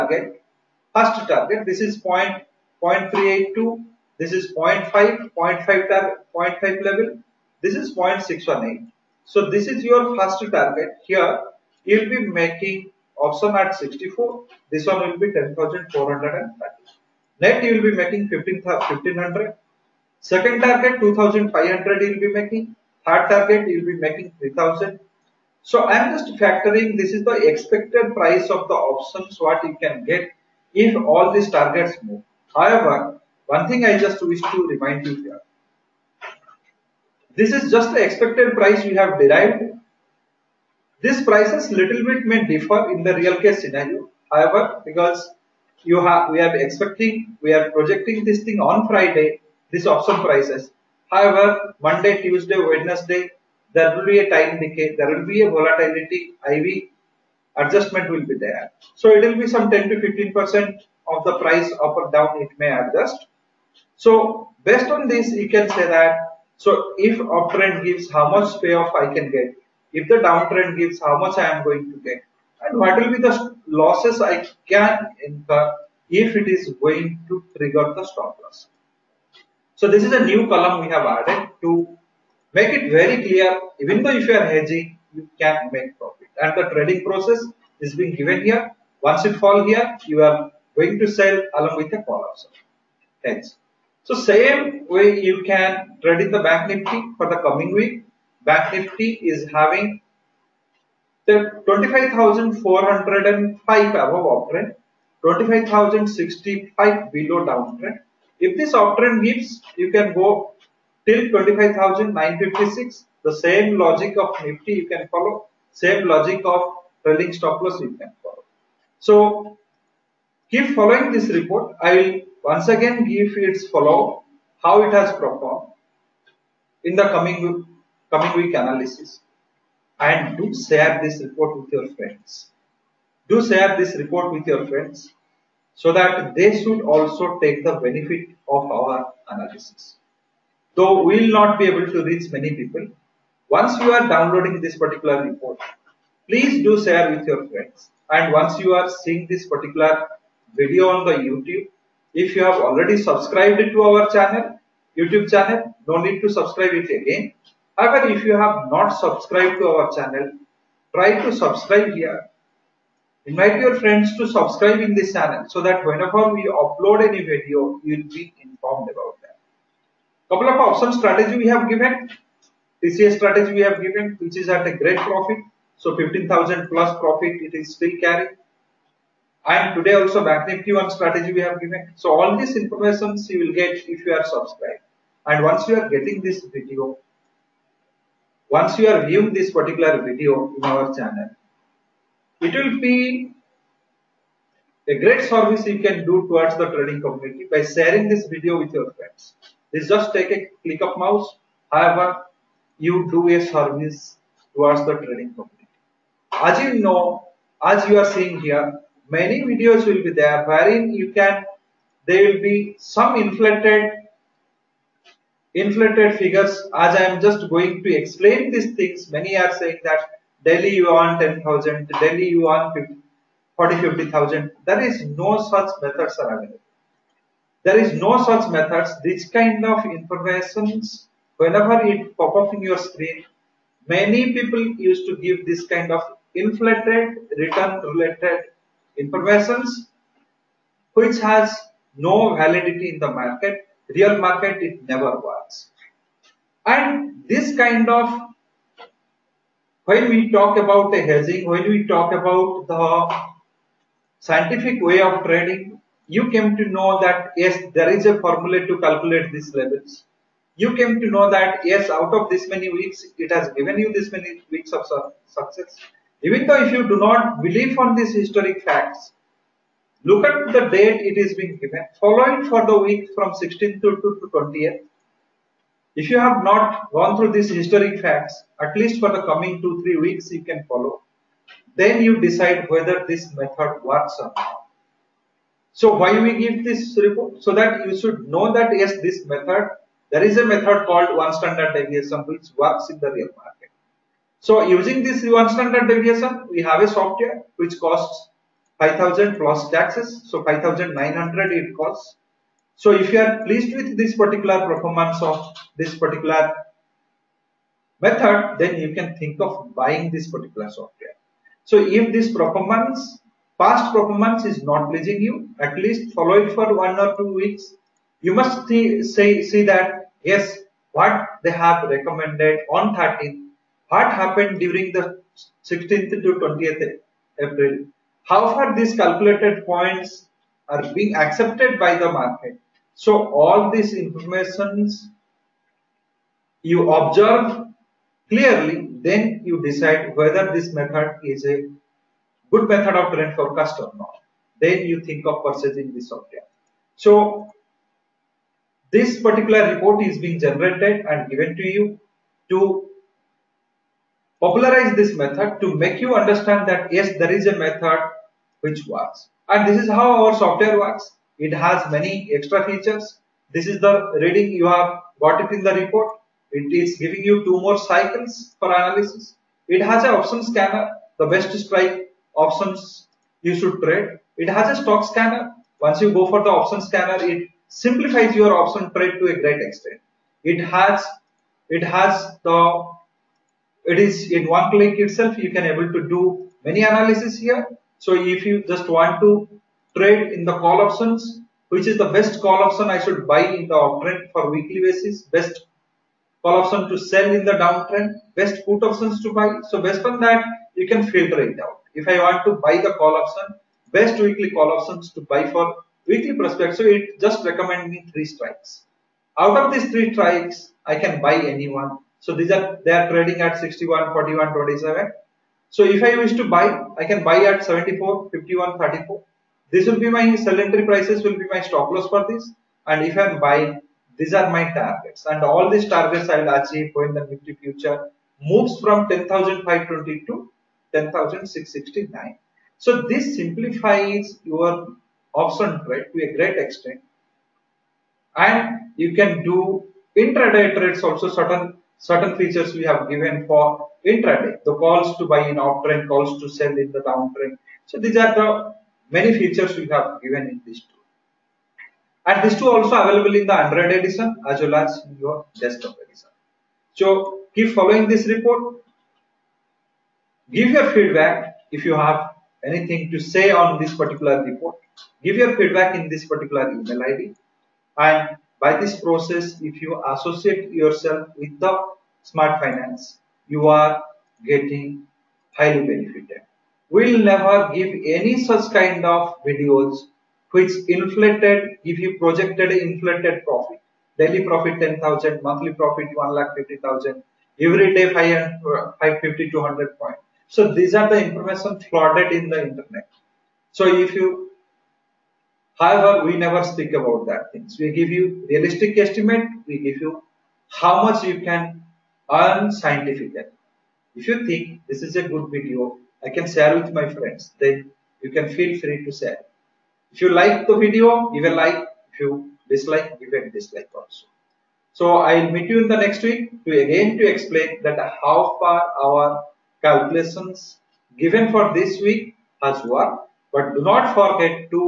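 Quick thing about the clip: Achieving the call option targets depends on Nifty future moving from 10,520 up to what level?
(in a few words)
10,669.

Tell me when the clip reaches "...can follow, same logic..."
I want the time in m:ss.
1:54.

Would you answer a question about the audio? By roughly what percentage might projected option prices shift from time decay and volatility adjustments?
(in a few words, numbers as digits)
10 to 15 percent.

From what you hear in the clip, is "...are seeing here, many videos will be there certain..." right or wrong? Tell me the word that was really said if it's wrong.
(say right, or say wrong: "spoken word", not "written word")
wrong: "wherein", not "certain".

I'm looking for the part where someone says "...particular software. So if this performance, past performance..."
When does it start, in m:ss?
5:10.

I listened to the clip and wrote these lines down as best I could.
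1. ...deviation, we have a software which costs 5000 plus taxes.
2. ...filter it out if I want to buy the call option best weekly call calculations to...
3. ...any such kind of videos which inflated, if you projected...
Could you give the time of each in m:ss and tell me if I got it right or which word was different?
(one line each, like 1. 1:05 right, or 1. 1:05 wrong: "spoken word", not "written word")
1. 4:55 right
2. 6:41 wrong: "options", not "calculations"
3. 7:58 right.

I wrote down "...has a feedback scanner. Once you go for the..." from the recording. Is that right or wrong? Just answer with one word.
wrong.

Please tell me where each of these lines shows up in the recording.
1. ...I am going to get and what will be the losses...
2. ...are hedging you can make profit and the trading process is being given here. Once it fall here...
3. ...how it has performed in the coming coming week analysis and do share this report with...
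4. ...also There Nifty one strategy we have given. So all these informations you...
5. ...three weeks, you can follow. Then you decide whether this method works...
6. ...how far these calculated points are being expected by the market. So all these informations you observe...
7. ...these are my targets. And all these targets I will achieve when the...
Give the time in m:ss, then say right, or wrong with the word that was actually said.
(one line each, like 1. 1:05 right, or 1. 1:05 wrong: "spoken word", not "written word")
1. 1:11 right
2. 1:24 right
3. 2:04 right
4. 3:00 wrong: "Bank", not "There"
5. 4:39 right
6. 5:28 wrong: "accepted", not "expected"
7. 7:04 right.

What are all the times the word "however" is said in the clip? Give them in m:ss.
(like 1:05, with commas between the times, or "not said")
0:32, 0:44, 0:51, 2:37, 3:21, 8:15.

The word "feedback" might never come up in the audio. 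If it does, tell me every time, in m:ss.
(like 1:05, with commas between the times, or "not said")
7:40, 7:45.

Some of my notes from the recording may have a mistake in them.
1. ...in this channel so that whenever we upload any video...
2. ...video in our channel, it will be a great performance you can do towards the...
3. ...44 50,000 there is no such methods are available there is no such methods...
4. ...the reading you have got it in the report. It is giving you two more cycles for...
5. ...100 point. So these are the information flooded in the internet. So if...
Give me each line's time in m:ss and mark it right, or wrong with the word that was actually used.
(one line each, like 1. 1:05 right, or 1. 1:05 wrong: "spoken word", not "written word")
1. 2:44 right
2. 3:10 wrong: "service", not "performance"
3. 3:43 wrong: "40", not "44"
4. 6:03 right
5. 8:09 right.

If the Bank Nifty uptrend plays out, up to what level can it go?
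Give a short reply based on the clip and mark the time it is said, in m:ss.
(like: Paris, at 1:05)
25,956, at 1:51.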